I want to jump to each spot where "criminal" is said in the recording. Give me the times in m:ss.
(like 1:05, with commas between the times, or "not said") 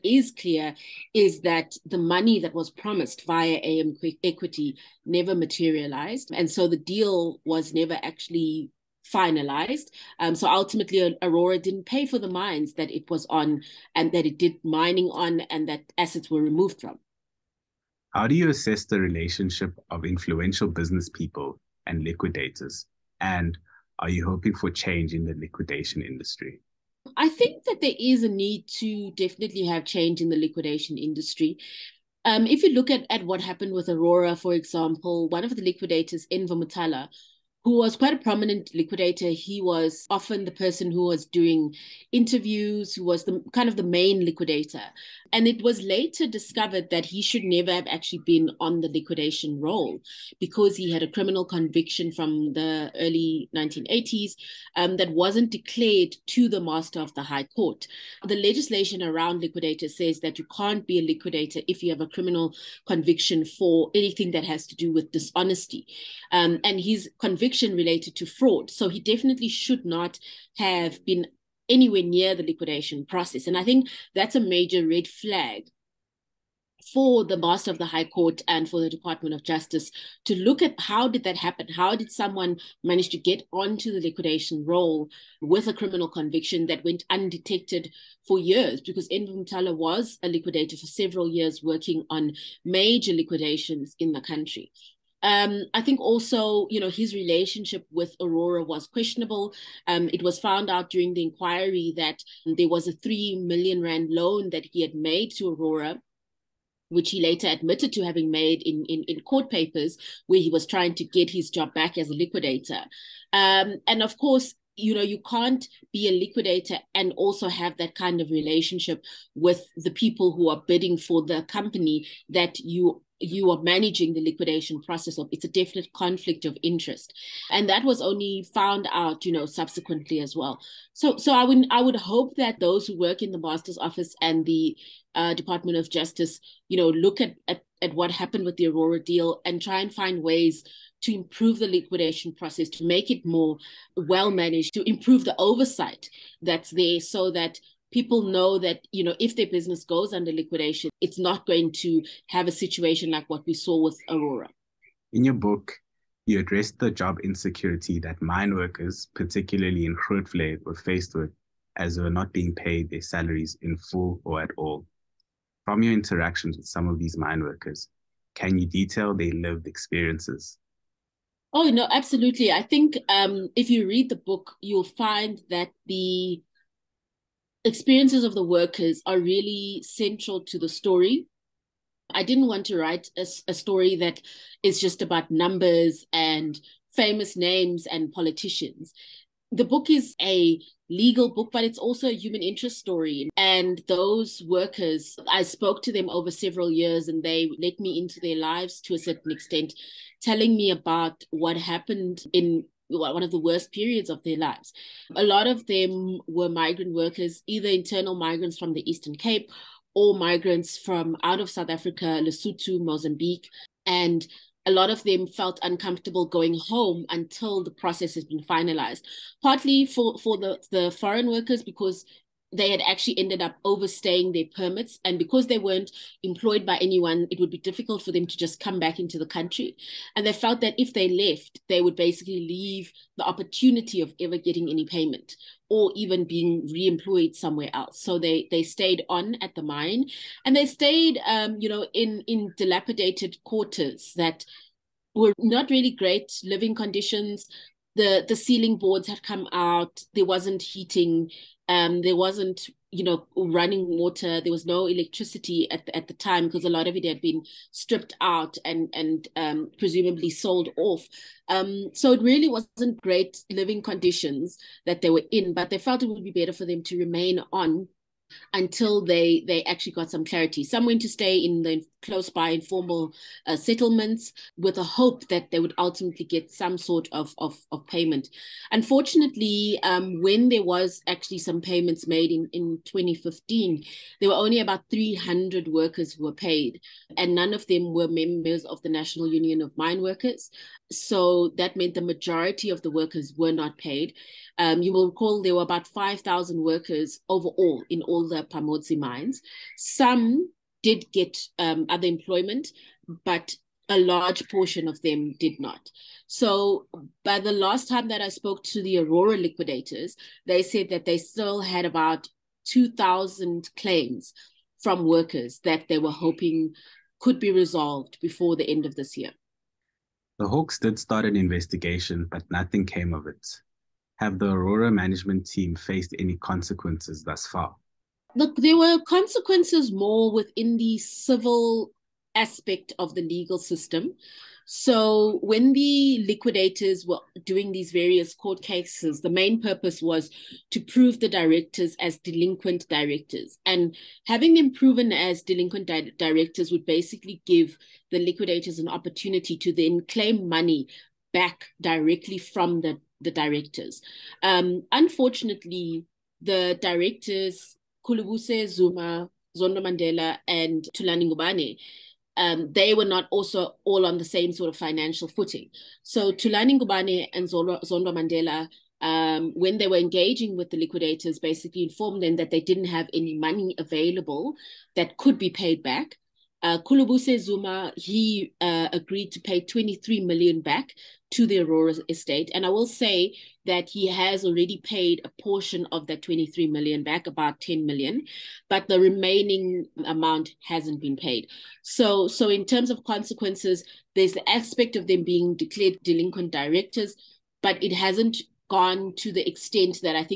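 0:51, 1:02, 1:25.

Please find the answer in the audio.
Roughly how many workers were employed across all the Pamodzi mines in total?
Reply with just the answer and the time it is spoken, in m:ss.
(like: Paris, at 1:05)
5,000, at 4:55.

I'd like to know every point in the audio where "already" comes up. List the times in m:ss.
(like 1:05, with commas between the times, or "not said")
6:24.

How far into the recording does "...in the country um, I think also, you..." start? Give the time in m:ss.
1:33.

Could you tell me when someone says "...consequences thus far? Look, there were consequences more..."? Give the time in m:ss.
5:26.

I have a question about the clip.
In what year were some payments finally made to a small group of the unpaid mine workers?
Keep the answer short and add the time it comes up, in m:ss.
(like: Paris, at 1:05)
2015, at 4:42.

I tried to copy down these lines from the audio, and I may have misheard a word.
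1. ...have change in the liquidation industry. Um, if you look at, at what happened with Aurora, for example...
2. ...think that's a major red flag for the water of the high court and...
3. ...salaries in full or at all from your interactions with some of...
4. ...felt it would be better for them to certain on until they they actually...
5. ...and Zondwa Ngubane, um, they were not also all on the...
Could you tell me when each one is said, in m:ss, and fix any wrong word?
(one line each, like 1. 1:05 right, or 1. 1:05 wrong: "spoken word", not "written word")
1. 0:29 right
2. 1:13 wrong: "master", not "water"
3. 2:43 right
4. 4:25 wrong: "remain", not "certain"
5. 6:00 wrong: "Thulani", not "Zondwa".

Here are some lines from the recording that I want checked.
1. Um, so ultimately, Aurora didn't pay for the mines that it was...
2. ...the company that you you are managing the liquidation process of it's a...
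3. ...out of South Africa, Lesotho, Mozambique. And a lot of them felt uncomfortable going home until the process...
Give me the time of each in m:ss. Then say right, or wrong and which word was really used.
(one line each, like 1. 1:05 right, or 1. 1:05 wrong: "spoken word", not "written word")
1. 0:10 right
2. 2:01 right
3. 3:31 right.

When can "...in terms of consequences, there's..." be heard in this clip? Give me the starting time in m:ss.
6:32.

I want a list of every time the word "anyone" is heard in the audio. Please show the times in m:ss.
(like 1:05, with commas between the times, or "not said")
3:46.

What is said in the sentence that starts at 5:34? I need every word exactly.
So when the liquidators were doing these various court cases, the main purpose was to prove the directors as delinquent directors.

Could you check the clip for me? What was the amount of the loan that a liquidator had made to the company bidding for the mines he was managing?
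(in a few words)
3 million Rand.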